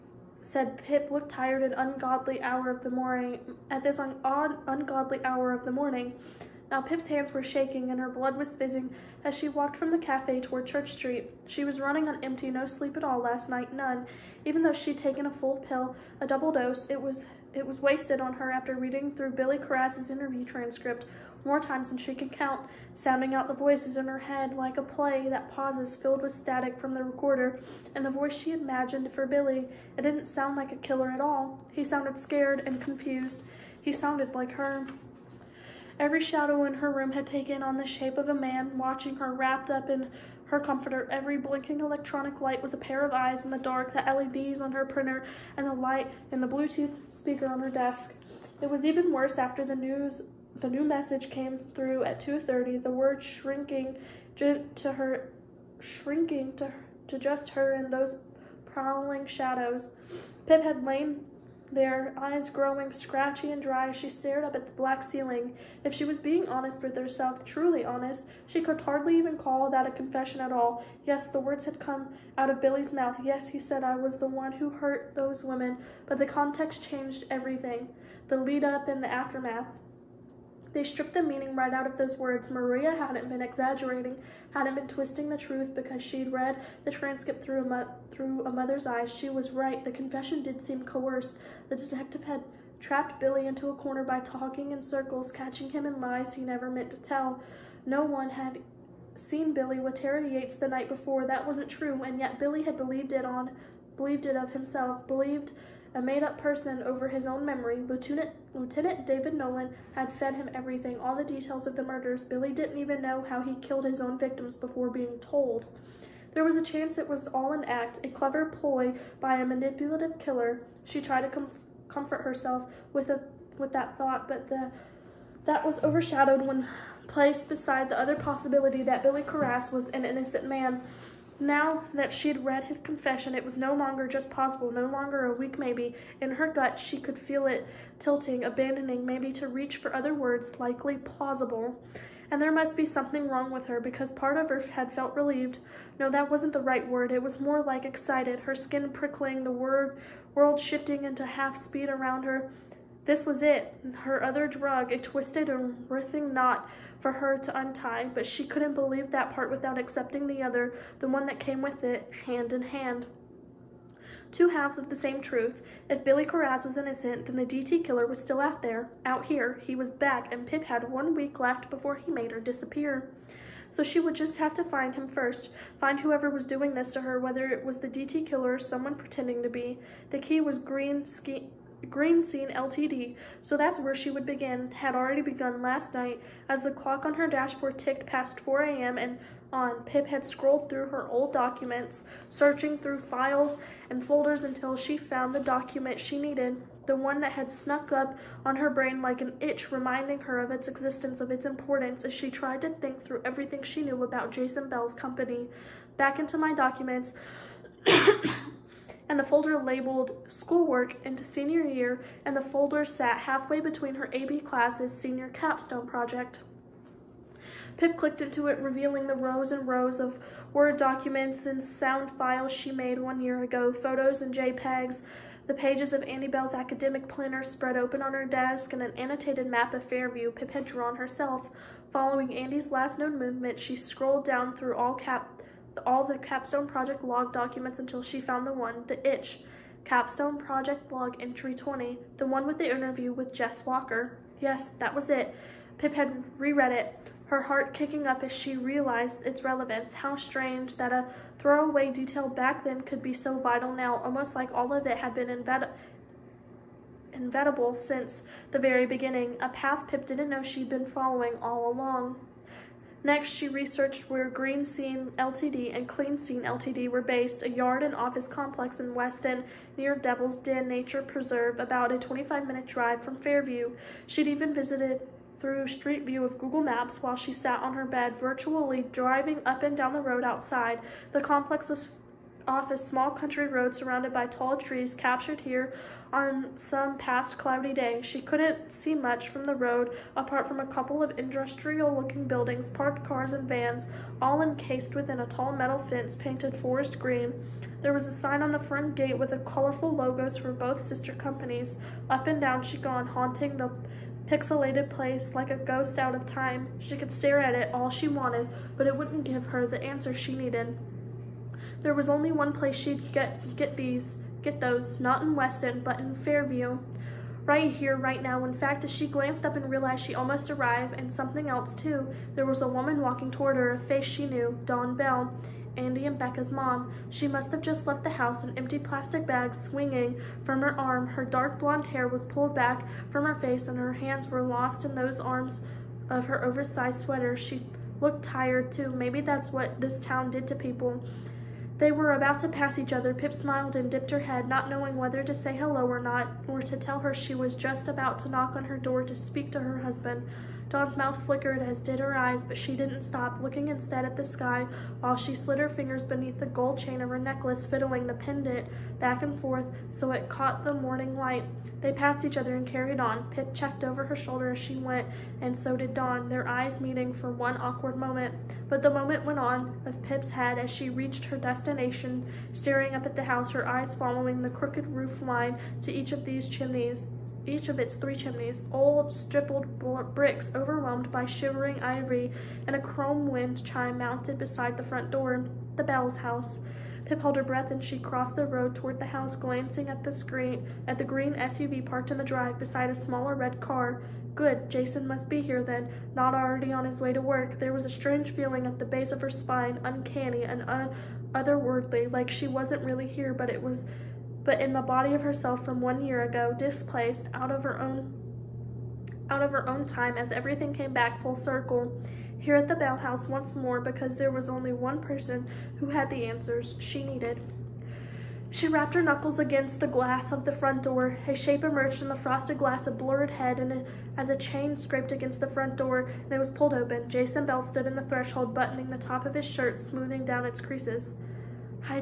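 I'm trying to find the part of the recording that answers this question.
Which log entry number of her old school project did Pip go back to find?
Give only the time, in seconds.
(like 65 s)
241 s.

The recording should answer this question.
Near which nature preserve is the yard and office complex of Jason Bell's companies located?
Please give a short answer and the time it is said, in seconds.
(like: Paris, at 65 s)
Devil's Den Nature Preserve, at 269 s.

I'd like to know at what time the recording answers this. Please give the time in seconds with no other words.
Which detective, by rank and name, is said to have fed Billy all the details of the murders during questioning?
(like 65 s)
108 s.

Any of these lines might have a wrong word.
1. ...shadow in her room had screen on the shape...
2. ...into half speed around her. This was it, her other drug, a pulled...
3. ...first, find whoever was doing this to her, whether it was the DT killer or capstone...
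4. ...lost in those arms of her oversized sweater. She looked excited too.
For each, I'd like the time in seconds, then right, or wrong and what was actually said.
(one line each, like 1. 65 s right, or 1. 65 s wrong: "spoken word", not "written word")
1. 36 s wrong: "taken", not "screen"
2. 151 s wrong: "twisted", not "pulled"
3. 175 s wrong: "someone", not "capstone"
4. 334 s wrong: "tired", not "excited".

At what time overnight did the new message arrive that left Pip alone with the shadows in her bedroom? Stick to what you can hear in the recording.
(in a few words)
2.30.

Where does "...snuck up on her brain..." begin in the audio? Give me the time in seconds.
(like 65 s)
197 s.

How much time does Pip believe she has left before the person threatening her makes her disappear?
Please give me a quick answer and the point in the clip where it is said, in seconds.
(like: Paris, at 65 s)
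one week, at 170 s.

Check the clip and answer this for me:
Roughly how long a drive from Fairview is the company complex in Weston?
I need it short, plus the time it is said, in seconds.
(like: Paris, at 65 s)
25 minutes, at 271 s.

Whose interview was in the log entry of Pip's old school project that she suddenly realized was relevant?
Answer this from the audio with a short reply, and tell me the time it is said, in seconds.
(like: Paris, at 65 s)
Jess Walker, at 243 s.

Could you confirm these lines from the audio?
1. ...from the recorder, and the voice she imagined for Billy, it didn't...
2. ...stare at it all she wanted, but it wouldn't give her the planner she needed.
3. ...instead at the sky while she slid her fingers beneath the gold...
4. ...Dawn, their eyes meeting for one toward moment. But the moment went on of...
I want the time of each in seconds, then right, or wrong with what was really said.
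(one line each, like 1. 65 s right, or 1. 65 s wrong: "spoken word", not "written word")
1. 26 s right
2. 307 s wrong: "answer", not "planner"
3. 353 s right
4. 365 s wrong: "awkward", not "toward".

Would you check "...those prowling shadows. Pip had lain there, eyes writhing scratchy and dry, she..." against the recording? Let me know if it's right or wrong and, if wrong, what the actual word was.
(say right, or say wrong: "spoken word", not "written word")
wrong: "growing", not "writhing".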